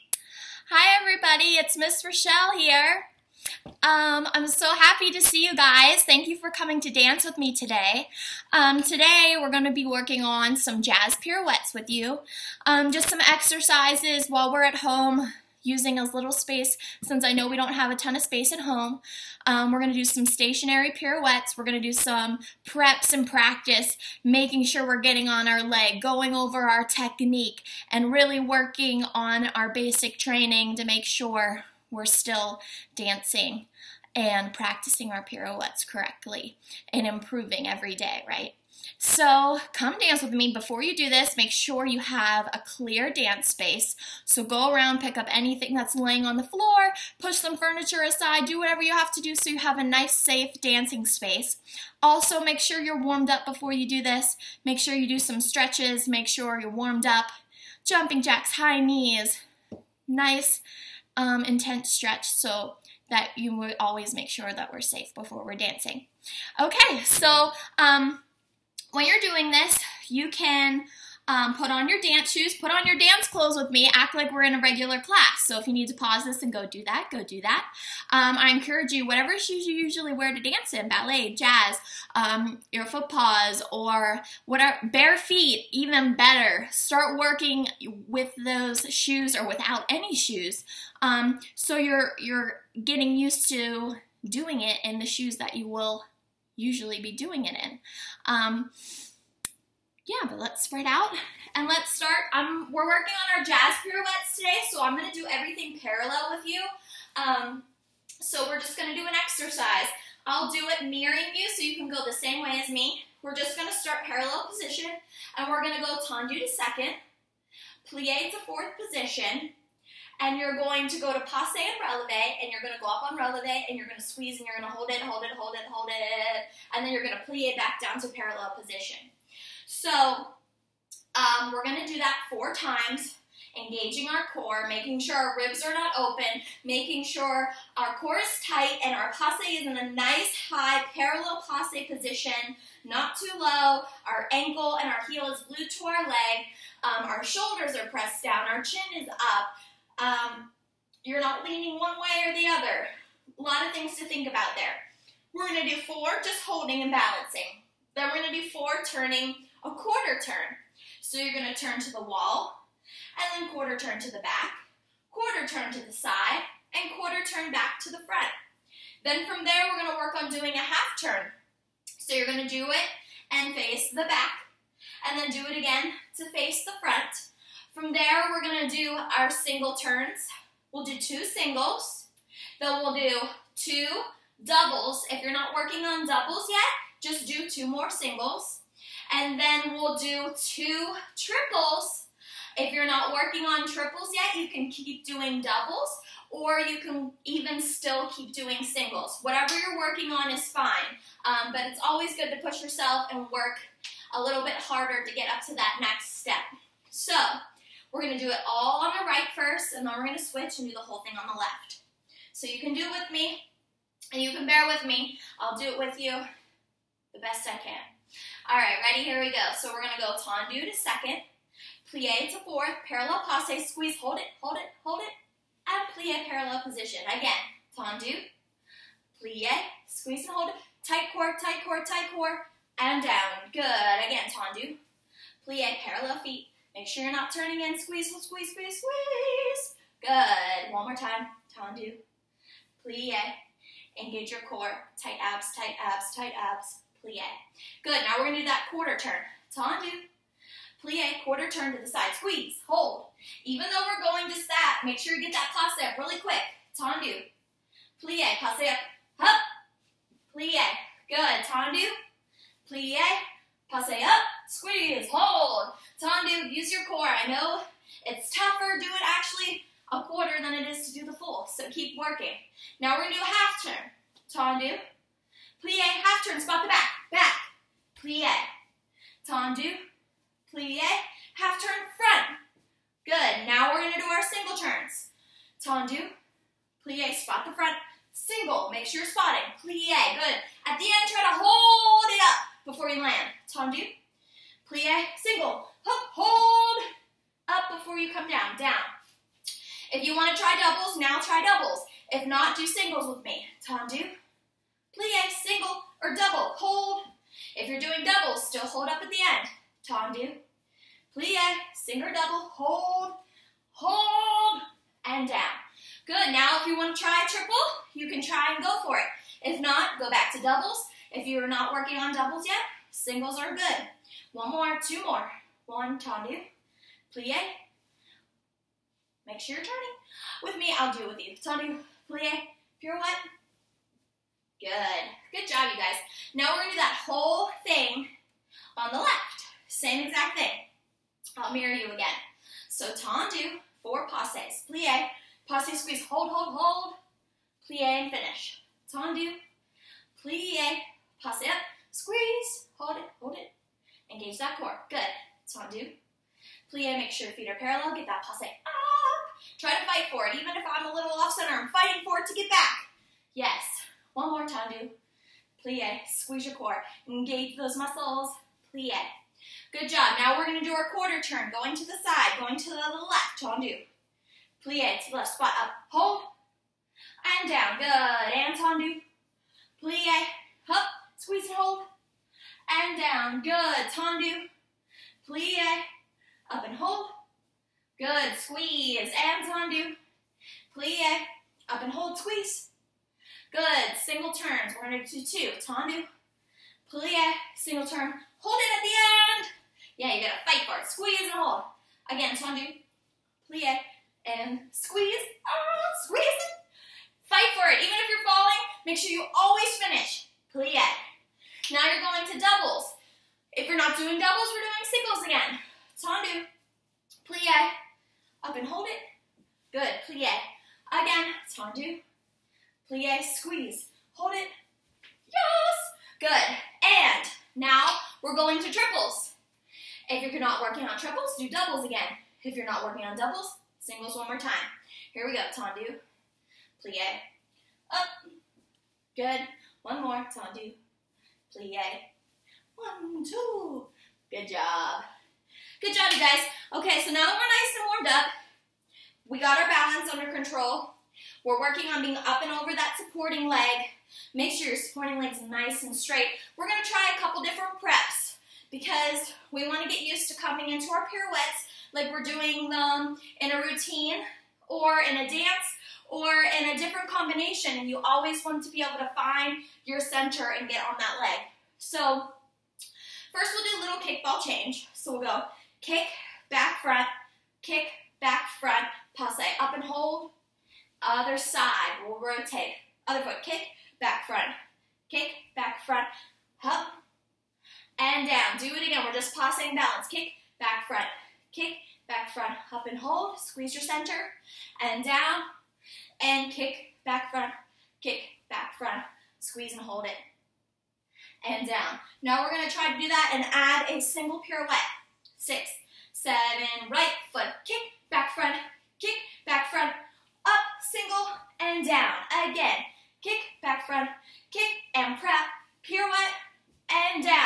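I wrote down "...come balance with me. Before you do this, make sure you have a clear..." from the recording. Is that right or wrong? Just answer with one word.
wrong.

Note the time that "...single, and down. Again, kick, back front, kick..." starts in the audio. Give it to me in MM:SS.
08:30.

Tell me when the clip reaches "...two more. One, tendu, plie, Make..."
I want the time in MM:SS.
05:24.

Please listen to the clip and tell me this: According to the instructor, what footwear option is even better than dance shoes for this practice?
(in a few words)
Bare feet.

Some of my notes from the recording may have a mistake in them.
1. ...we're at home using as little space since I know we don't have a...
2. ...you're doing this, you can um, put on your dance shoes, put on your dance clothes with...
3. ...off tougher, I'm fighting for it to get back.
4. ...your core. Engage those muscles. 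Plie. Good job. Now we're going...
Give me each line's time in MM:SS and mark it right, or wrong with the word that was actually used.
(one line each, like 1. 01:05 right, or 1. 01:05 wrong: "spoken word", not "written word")
1. 00:14 right
2. 01:09 right
3. 06:01 wrong: "center", not "tougher"
4. 06:06 right.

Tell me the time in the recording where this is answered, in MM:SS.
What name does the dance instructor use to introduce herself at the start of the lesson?
00:01.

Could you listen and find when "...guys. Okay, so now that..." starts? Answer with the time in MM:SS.
07:26.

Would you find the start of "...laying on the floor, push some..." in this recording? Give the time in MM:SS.
00:45.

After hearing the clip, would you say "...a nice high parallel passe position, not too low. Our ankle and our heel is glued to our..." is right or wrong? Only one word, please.
right.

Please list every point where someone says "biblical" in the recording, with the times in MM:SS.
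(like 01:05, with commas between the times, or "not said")
not said.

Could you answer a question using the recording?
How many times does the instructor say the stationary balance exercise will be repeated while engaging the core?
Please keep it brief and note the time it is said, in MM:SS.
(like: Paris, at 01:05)
4, at 02:12.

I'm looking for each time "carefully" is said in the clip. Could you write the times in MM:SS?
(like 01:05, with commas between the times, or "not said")
not said.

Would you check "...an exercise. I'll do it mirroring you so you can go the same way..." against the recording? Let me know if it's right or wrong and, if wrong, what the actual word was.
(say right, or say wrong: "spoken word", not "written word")
right.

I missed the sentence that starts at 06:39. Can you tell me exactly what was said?
Yeah, you gotta fight for it, squeeze and hold.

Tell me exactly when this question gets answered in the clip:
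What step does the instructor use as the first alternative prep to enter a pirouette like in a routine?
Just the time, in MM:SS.
07:54.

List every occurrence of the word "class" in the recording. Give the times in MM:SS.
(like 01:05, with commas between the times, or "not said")
01:14.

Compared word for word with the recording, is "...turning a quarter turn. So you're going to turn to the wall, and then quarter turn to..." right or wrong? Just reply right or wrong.
right.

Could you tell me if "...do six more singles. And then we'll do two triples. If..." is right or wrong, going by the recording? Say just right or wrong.
wrong.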